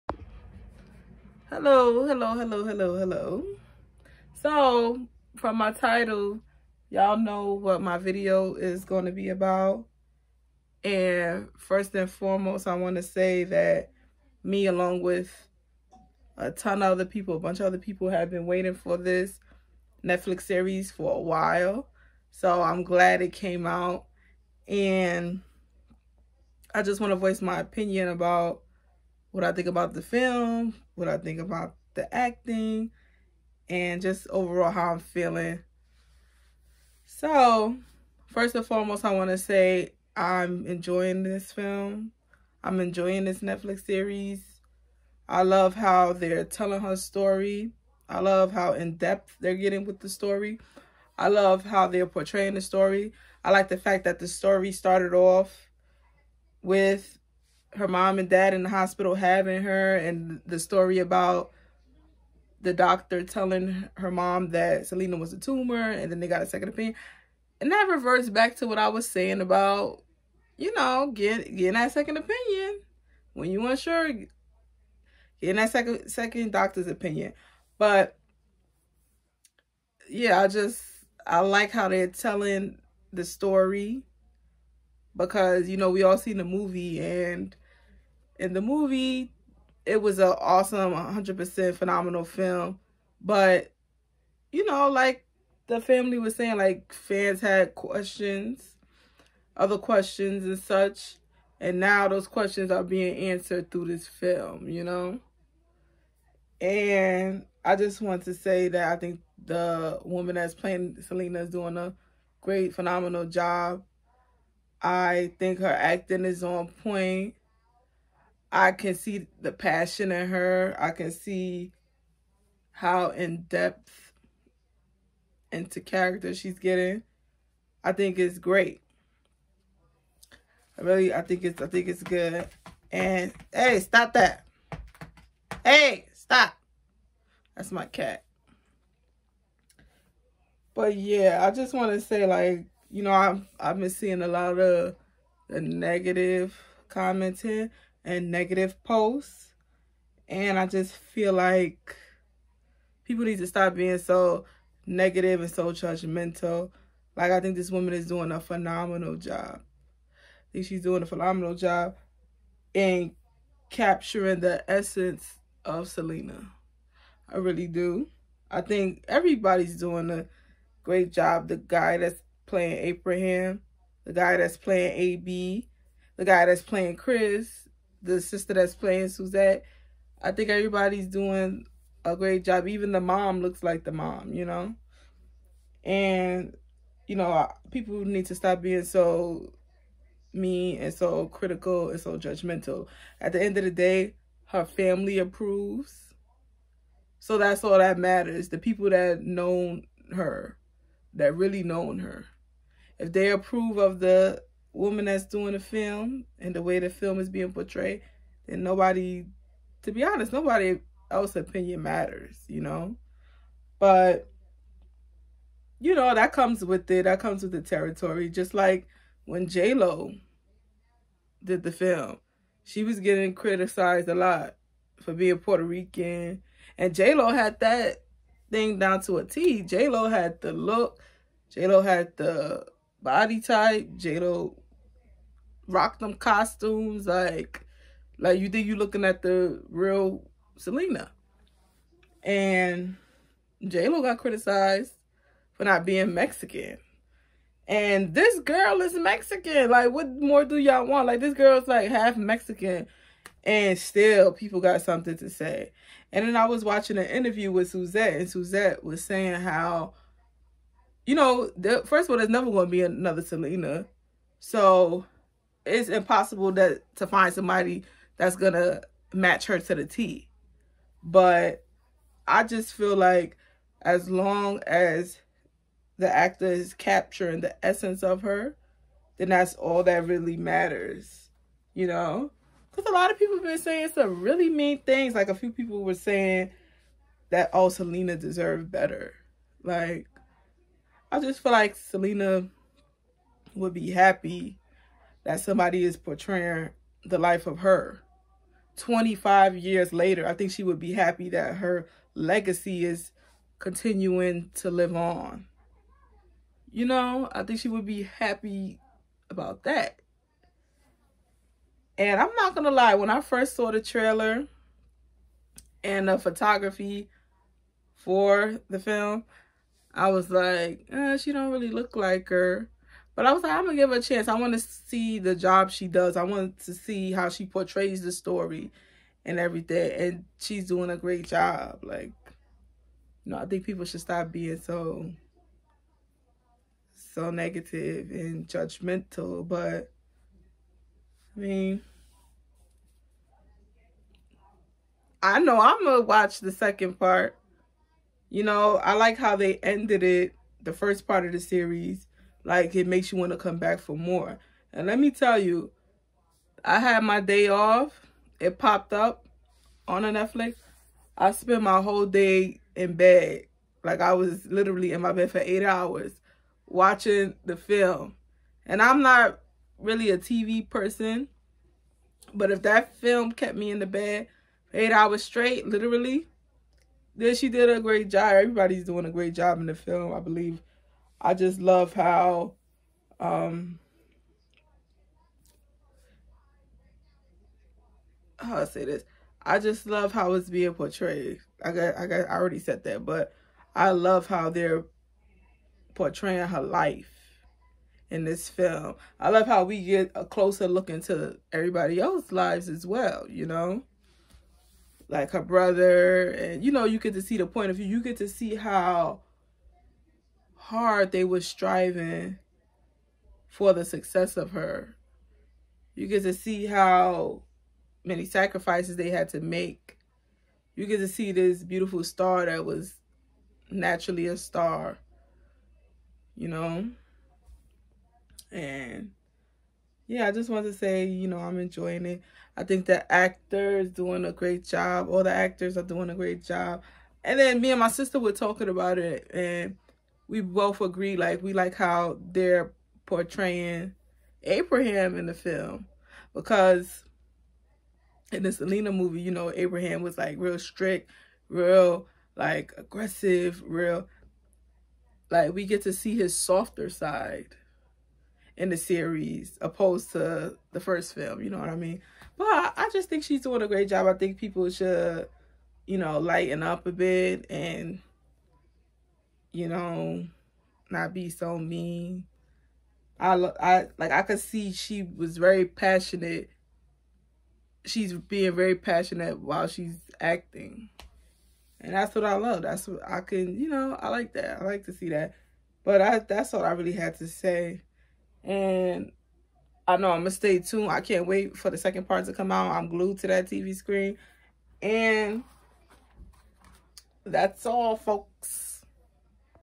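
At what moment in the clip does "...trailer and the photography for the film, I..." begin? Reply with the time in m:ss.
5:13.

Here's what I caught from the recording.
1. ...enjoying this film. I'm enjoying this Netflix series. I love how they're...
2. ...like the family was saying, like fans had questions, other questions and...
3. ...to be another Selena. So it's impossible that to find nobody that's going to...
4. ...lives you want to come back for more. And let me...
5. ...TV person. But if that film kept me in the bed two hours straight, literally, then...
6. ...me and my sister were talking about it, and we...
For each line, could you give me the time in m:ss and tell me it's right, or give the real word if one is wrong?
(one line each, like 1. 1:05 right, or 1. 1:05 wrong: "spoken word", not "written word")
1. 0:40 right
2. 1:34 right
3. 4:22 wrong: "somebody", not "nobody"
4. 5:52 wrong: "makes", not "lives"
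5. 6:10 wrong: "eight", not "two"
6. 7:17 right.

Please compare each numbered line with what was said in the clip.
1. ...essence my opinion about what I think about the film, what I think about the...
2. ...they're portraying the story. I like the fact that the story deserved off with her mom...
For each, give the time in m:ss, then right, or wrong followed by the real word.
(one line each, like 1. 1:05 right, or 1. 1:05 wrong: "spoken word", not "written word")
1. 0:27 wrong: "voice", not "essence"
2. 0:51 wrong: "started", not "deserved".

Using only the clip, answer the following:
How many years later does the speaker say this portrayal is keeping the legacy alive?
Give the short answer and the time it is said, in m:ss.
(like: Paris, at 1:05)
25, at 4:58.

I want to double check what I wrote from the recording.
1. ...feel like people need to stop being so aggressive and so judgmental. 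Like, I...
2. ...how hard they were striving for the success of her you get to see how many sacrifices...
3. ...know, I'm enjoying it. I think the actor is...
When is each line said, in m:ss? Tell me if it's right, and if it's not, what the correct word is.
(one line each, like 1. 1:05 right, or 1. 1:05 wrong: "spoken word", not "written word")
1. 2:30 wrong: "negative", not "aggressive"
2. 6:48 right
3. 7:11 right.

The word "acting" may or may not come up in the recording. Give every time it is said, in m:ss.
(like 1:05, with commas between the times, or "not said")
0:32, 1:55, 8:00.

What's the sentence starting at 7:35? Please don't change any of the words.
Like, we get to see his softer side in the series opposed to the first film.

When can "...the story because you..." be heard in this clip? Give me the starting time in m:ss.
1:23.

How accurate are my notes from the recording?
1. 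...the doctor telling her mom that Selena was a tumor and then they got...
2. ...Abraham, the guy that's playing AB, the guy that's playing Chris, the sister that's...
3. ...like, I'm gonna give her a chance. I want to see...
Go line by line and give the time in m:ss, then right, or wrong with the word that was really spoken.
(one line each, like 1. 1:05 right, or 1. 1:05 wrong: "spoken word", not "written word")
1. 1:02 right
2. 2:52 right
3. 5:23 right.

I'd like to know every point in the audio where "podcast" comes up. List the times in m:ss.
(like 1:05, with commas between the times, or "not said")
not said.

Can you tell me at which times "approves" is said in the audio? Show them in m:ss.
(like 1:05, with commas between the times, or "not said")
3:15, 3:23.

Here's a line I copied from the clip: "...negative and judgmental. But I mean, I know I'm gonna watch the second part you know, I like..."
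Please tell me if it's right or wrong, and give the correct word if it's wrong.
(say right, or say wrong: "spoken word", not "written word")
right.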